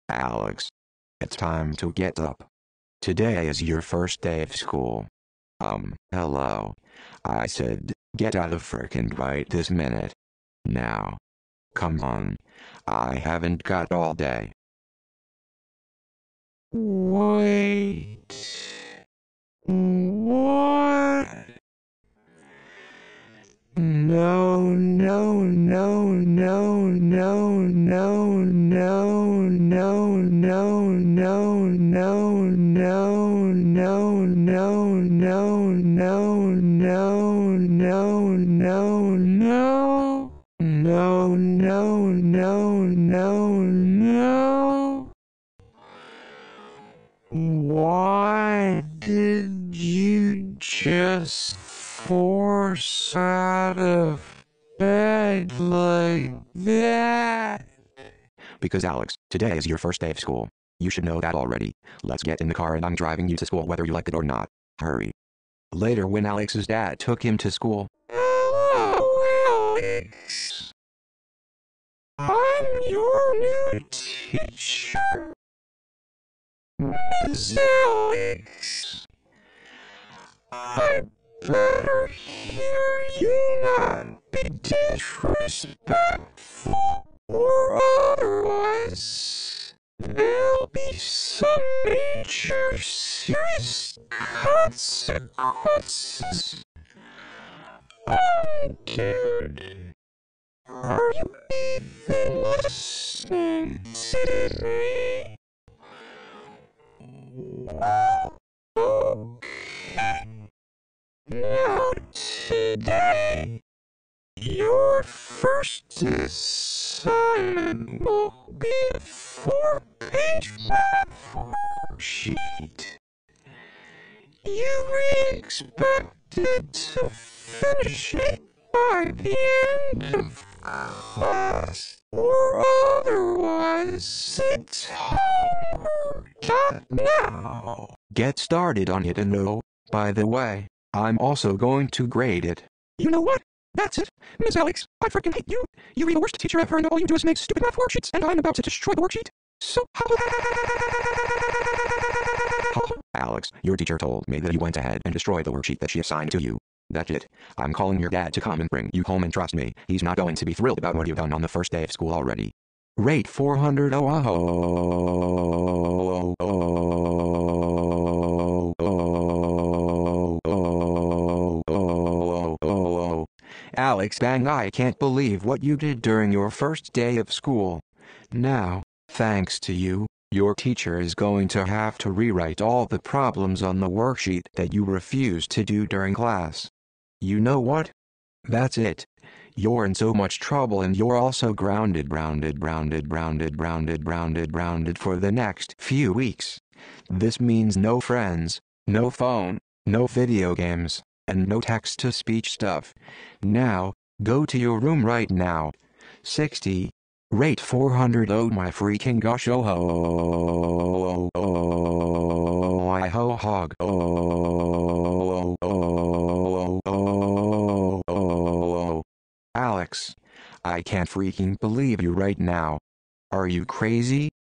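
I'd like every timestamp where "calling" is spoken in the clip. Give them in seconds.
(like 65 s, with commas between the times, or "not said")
157 s.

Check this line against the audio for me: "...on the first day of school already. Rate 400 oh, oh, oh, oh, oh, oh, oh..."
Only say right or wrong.
right.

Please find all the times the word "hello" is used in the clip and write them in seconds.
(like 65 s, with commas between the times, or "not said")
6 s, 68 s.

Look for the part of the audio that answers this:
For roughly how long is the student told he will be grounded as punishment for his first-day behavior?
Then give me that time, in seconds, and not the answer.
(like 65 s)
195 s.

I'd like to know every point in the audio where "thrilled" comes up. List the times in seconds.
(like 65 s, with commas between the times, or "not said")
160 s.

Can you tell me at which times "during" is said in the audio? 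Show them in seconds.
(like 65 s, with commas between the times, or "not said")
176 s, 185 s.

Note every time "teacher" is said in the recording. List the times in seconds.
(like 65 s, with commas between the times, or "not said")
73 s, 146 s, 153 s, 180 s.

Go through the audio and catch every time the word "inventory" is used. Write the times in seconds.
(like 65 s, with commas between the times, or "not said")
not said.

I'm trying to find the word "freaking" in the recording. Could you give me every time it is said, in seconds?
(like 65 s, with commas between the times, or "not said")
145 s, 208 s, 221 s.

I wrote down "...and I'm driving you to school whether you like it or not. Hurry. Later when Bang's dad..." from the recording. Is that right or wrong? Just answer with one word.
wrong.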